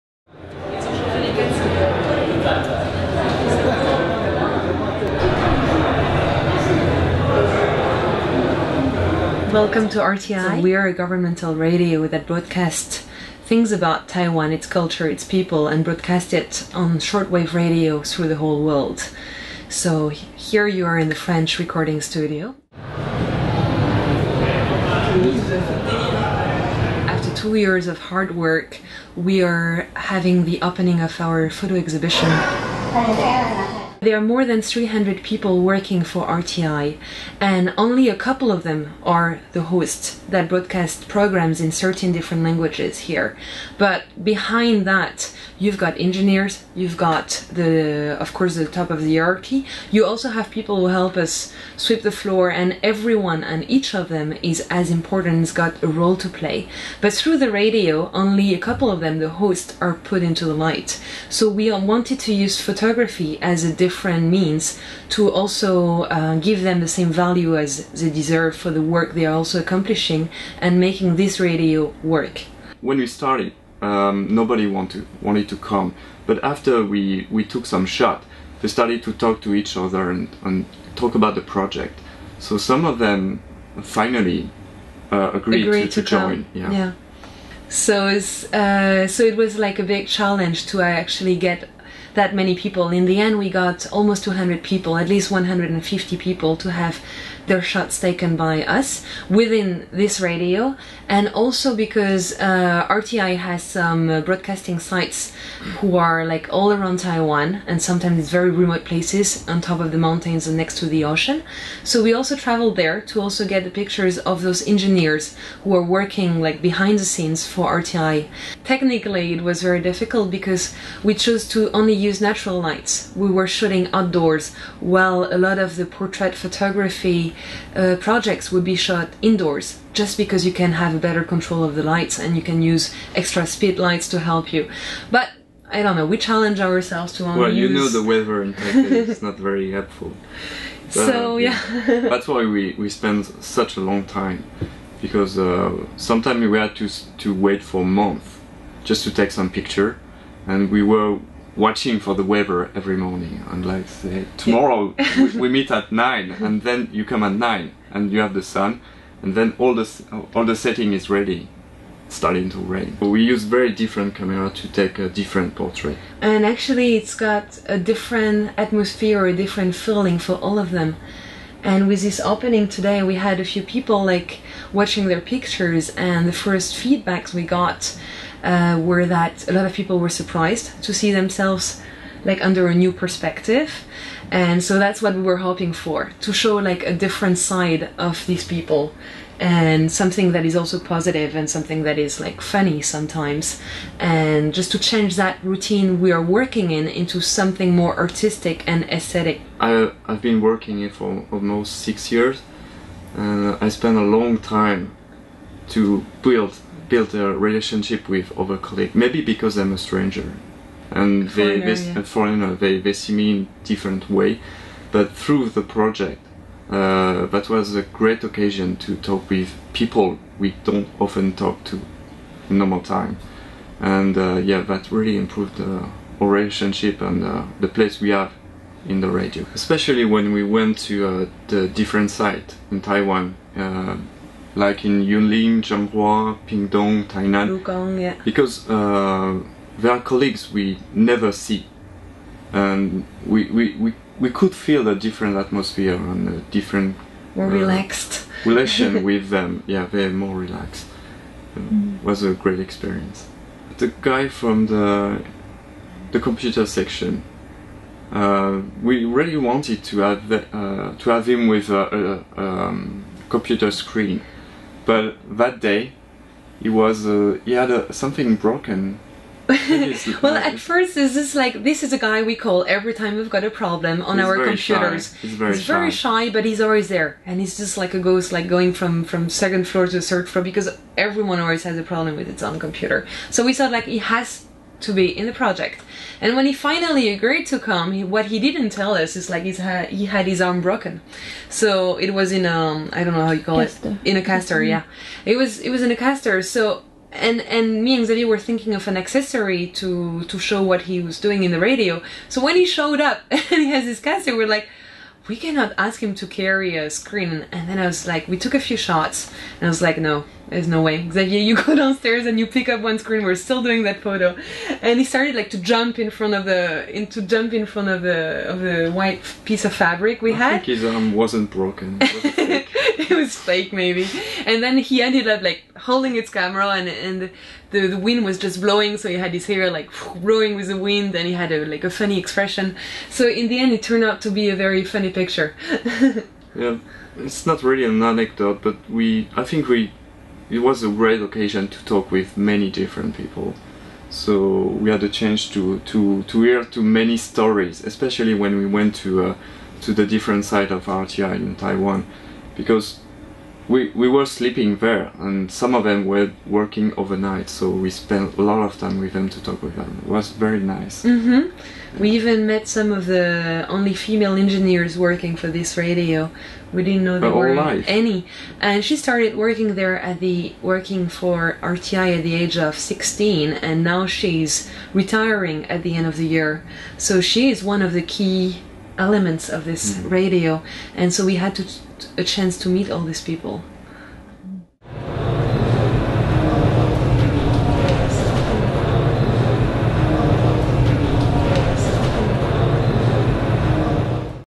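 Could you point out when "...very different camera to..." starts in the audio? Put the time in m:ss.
2:43.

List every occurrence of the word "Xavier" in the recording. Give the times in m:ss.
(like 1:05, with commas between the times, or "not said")
4:58, 5:11.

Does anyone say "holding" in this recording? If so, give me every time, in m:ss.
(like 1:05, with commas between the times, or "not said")
5:25.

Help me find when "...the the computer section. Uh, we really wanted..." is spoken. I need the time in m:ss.
4:14.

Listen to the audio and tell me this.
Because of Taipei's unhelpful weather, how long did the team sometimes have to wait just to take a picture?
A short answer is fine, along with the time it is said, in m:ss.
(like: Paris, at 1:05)
A month, at 2:27.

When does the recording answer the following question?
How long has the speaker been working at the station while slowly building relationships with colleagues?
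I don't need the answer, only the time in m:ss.
3:21.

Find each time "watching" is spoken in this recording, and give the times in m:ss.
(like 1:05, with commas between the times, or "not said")
2:31, 2:54.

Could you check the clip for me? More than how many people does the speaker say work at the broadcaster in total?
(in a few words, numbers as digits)
300.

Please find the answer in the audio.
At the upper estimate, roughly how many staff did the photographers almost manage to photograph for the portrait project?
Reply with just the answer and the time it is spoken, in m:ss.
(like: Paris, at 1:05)
200, at 1:34.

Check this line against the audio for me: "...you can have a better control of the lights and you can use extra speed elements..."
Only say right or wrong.
wrong.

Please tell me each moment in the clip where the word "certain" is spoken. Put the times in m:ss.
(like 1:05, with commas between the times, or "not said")
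0:41.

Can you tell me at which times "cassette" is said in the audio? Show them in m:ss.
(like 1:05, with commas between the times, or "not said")
5:03.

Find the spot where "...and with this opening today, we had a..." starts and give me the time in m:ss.
2:51.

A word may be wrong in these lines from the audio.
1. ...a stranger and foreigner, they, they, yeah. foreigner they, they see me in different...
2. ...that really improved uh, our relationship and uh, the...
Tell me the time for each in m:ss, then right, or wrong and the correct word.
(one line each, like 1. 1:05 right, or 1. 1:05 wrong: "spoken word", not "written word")
1. 3:29 right
2. 3:44 right.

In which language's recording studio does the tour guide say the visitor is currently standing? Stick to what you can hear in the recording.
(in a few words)
French.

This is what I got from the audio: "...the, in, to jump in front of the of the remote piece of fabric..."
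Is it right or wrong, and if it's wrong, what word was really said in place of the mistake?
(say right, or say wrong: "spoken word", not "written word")
wrong: "white", not "remote".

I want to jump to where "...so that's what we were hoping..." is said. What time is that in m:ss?
3:04.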